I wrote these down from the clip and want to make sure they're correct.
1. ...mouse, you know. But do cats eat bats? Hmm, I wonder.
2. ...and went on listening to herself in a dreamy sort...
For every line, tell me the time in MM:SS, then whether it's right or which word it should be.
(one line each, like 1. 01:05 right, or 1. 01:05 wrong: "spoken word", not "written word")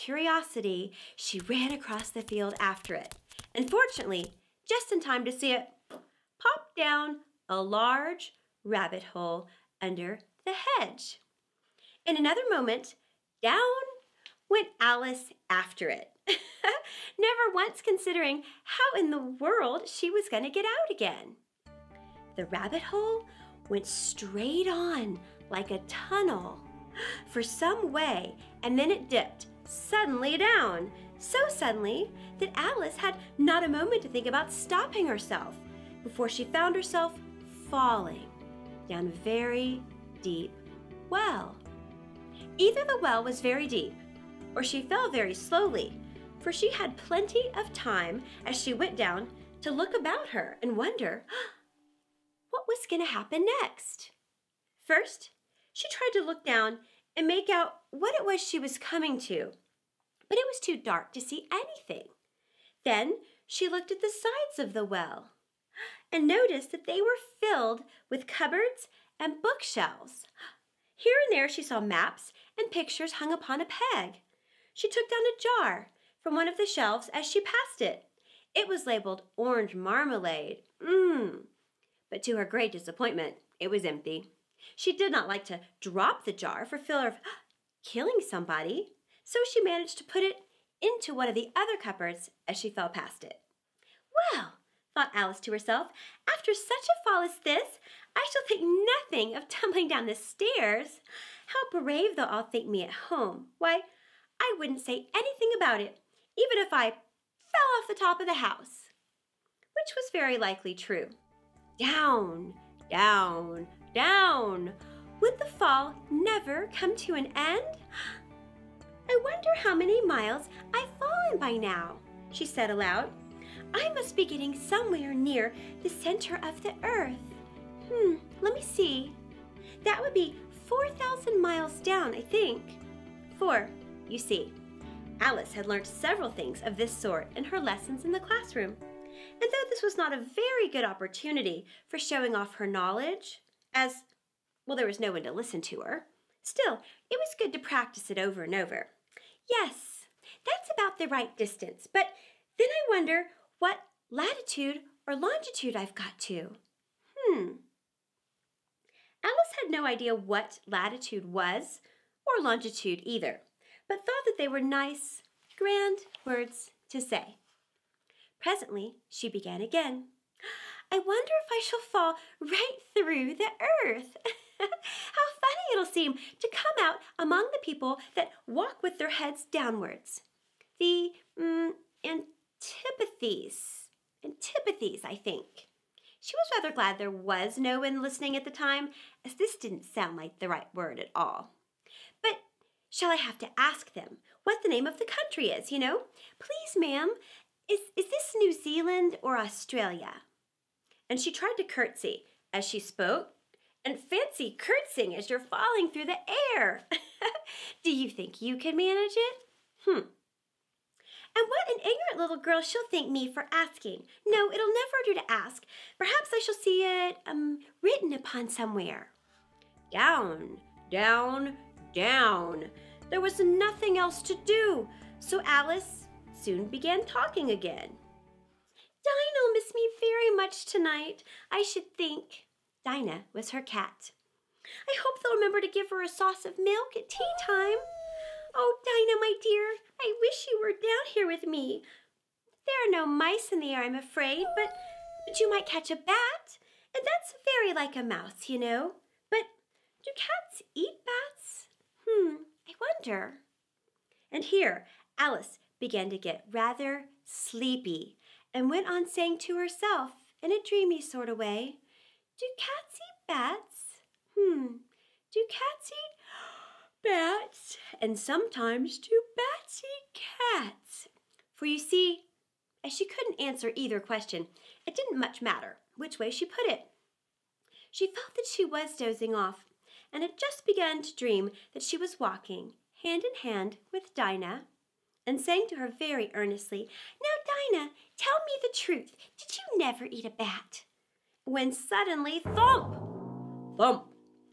1. 04:08 right
2. 04:18 wrong: "saying", not "listening".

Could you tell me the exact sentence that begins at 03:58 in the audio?
Oh, Dinah, my dear, I wish you were down here with me.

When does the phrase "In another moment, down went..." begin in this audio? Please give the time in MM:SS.
00:12.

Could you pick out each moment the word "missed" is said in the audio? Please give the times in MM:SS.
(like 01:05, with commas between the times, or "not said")
03:49.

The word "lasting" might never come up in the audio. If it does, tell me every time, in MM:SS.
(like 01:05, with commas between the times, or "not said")
not said.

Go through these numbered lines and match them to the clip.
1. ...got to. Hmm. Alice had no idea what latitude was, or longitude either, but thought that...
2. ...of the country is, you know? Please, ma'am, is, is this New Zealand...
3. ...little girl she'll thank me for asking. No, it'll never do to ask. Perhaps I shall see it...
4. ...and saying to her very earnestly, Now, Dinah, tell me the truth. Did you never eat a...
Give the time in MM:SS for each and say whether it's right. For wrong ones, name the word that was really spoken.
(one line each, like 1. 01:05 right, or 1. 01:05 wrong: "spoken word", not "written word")
1. 02:35 right
2. 03:14 right
3. 03:32 right
4. 04:45 right.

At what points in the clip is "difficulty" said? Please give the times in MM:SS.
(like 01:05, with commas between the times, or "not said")
not said.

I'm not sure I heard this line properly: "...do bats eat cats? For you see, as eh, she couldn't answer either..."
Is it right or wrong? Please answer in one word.
right.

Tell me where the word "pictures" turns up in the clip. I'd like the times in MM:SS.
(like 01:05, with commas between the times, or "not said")
01:12.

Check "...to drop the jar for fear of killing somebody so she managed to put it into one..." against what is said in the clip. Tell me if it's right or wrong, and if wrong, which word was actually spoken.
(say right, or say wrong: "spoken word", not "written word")
right.